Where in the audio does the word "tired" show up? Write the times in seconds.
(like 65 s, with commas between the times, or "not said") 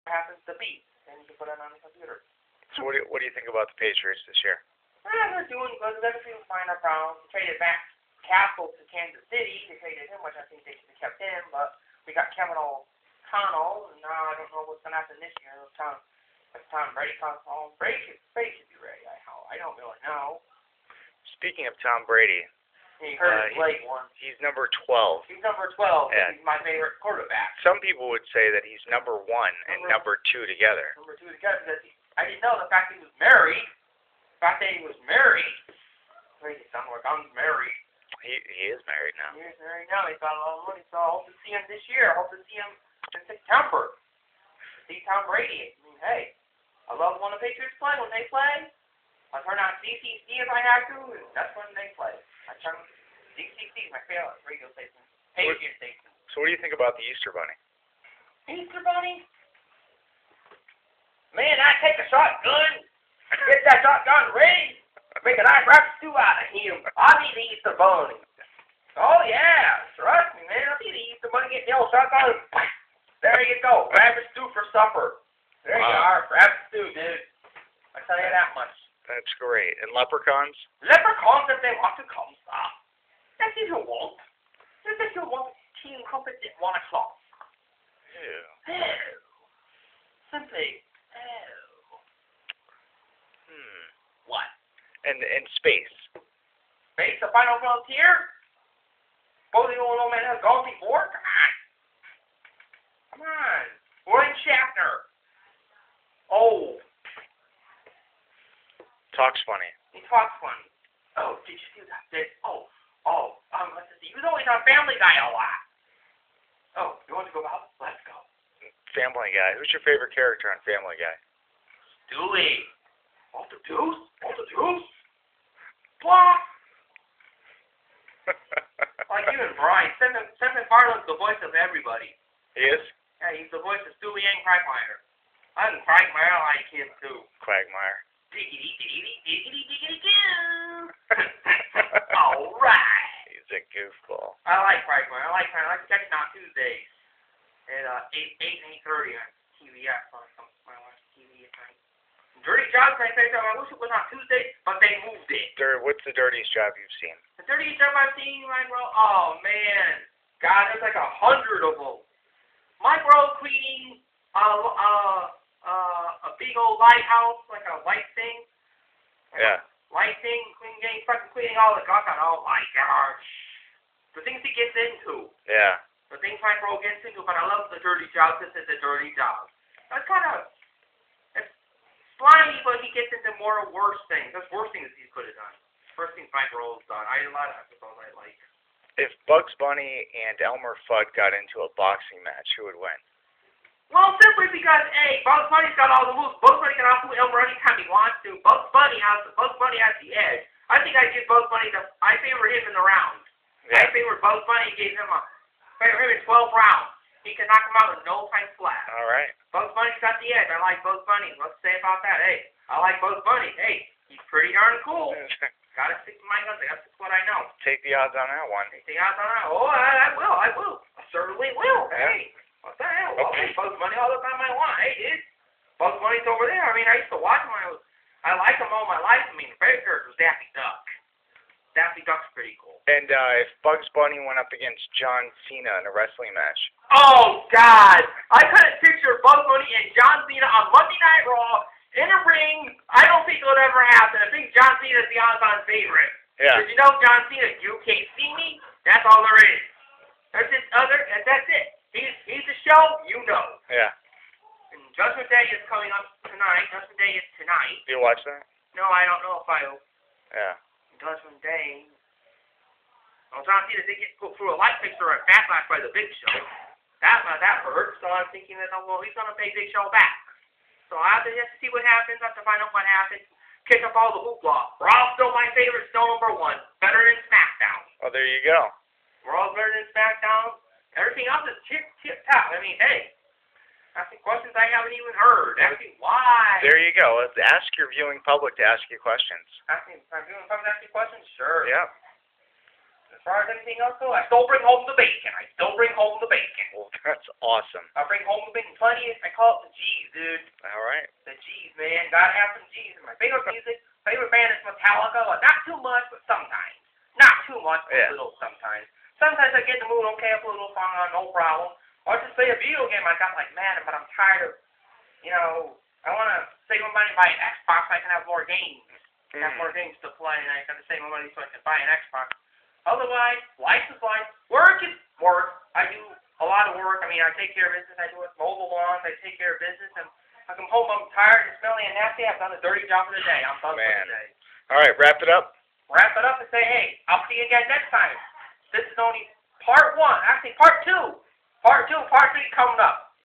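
314 s, 331 s.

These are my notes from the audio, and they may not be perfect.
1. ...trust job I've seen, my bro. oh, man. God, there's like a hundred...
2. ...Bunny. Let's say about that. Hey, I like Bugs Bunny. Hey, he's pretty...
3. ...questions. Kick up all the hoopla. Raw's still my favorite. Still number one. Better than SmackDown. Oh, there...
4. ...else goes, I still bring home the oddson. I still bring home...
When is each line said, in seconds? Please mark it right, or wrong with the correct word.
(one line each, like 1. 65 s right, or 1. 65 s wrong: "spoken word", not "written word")
1. 157 s wrong: "dirtiest", not "trust"
2. 211 s right
3. 272 s wrong: "happens", not "questions"
4. 293 s wrong: "bacon", not "oddson".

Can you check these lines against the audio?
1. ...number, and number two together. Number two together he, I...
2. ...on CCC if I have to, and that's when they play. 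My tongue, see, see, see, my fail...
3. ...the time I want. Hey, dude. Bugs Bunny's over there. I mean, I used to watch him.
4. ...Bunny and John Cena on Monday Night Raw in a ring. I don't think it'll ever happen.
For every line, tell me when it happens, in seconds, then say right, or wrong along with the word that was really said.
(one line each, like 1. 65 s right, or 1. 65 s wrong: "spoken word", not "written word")
1. 29 s right
2. 49 s right
3. 224 s right
4. 239 s right.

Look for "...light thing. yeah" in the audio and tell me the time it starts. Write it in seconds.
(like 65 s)
167 s.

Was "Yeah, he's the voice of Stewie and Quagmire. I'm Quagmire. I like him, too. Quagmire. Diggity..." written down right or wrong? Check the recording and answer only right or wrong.
right.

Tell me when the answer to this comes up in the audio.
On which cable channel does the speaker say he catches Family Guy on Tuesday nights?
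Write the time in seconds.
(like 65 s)
149 s.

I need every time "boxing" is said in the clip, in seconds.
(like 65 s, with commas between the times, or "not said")
191 s.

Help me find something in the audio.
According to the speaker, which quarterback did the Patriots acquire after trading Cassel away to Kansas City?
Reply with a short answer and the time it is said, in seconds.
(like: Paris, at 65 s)
Kevin O'Connell, at 12 s.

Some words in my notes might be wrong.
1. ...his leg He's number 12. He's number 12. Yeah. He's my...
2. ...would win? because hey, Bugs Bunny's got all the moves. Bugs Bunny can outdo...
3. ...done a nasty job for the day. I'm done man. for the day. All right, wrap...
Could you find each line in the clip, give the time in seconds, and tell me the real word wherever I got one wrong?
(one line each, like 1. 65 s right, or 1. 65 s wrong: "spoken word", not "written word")
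1. 23 s right
2. 192 s right
3. 332 s wrong: "dirty", not "nasty".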